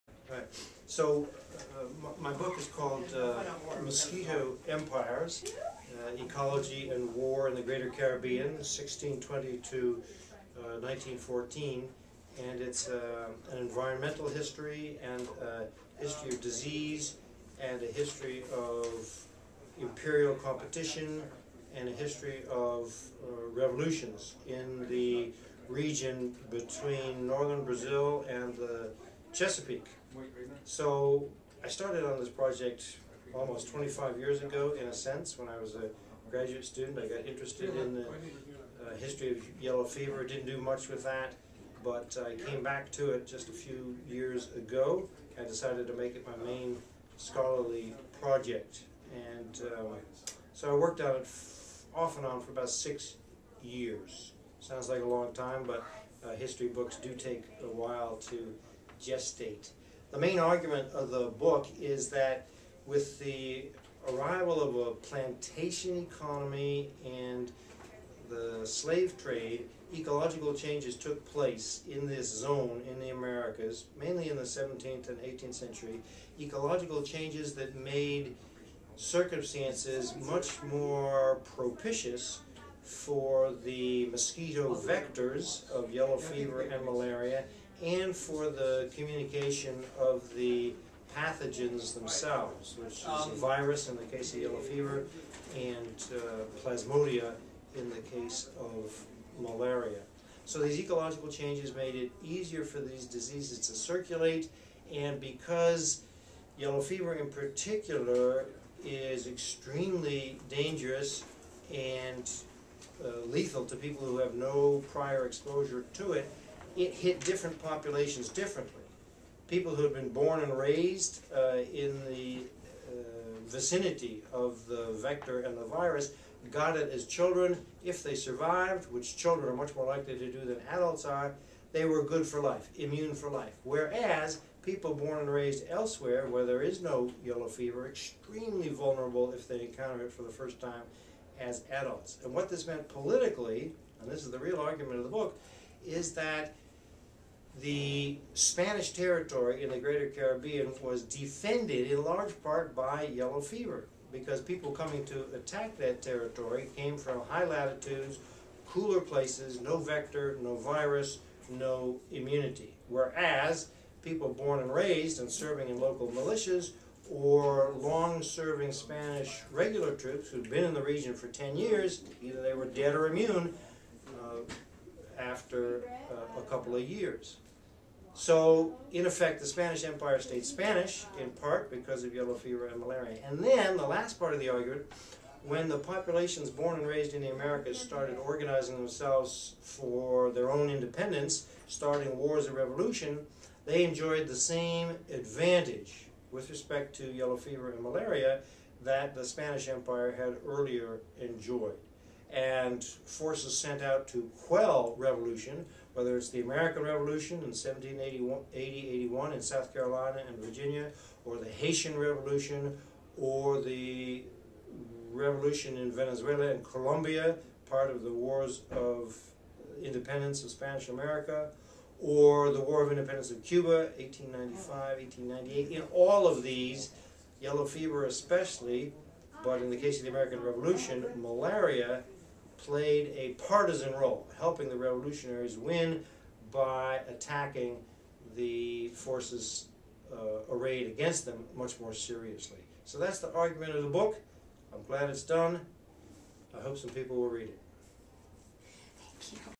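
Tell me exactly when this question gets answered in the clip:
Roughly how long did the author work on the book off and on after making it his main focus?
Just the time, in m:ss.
0:52.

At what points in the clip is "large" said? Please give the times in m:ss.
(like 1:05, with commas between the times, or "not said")
2:32.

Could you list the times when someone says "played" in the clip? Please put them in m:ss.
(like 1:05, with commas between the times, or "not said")
3:52.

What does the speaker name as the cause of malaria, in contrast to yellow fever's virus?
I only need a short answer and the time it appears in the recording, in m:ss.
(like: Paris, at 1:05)
Plasmodia, at 1:36.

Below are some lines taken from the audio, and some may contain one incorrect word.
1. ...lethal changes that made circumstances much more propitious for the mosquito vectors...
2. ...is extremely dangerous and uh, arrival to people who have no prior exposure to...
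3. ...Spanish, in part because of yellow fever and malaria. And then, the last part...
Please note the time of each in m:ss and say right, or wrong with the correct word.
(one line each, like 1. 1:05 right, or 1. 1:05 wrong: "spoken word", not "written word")
1. 1:16 wrong: "ecological", not "lethal"
2. 1:48 wrong: "lethal", not "arrival"
3. 3:00 right.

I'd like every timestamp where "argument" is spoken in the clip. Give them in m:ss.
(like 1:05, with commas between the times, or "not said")
1:00, 2:24, 3:04, 4:03.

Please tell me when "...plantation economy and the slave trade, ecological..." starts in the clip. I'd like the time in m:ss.
1:04.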